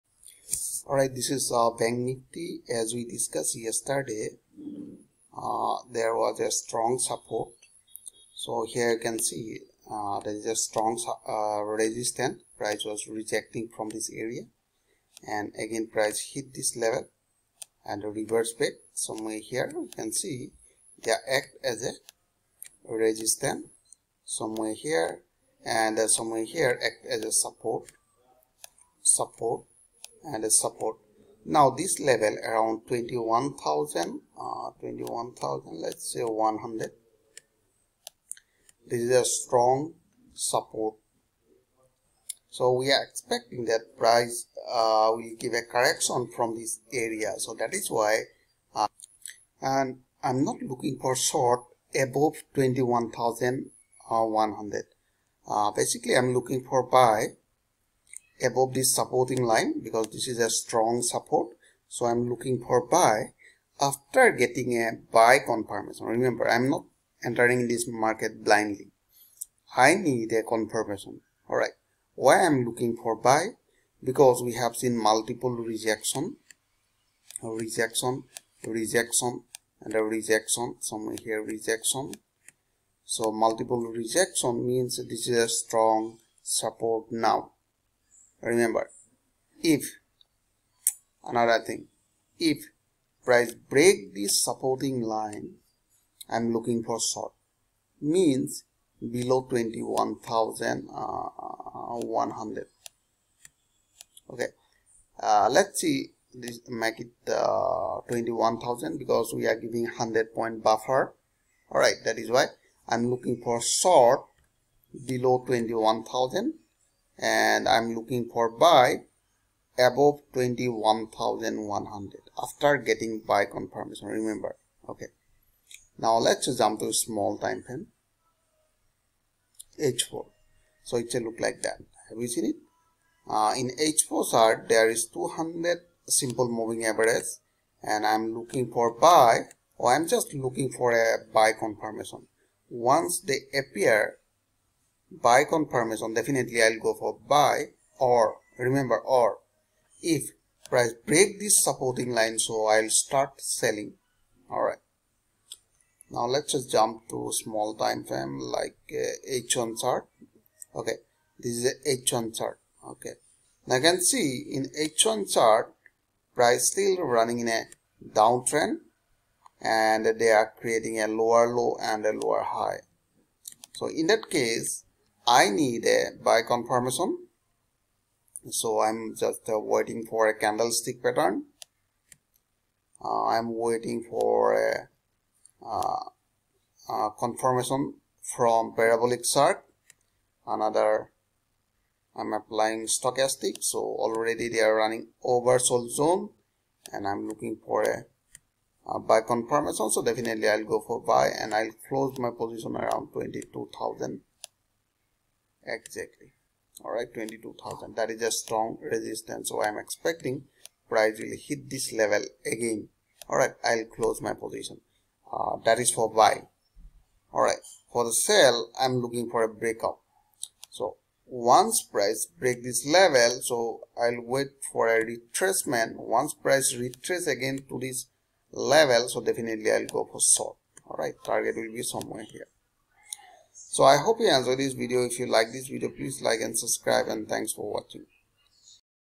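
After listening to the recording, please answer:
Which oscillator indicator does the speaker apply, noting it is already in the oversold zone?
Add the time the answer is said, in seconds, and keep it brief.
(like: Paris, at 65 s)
Stochastic, at 192 s.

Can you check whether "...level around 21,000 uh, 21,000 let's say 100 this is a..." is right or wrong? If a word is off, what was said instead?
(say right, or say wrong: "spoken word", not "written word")
right.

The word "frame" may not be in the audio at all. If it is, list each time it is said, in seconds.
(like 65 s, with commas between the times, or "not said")
127 s, 158 s.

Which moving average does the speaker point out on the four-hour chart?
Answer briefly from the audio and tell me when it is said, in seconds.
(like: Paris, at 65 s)
200 simple moving average, at 135 s.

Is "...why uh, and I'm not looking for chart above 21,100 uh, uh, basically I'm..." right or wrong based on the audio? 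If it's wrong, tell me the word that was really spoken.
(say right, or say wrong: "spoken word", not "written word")
wrong: "short", not "chart".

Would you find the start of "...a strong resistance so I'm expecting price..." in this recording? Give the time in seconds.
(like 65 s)
208 s.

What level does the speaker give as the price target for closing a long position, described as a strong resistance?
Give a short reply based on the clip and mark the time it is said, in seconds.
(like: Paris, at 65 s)
22,000, at 203 s.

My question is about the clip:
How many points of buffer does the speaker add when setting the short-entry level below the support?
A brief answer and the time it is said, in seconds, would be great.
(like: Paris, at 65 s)
100, at 109 s.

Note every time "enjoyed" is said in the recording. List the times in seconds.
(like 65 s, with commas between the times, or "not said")
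234 s.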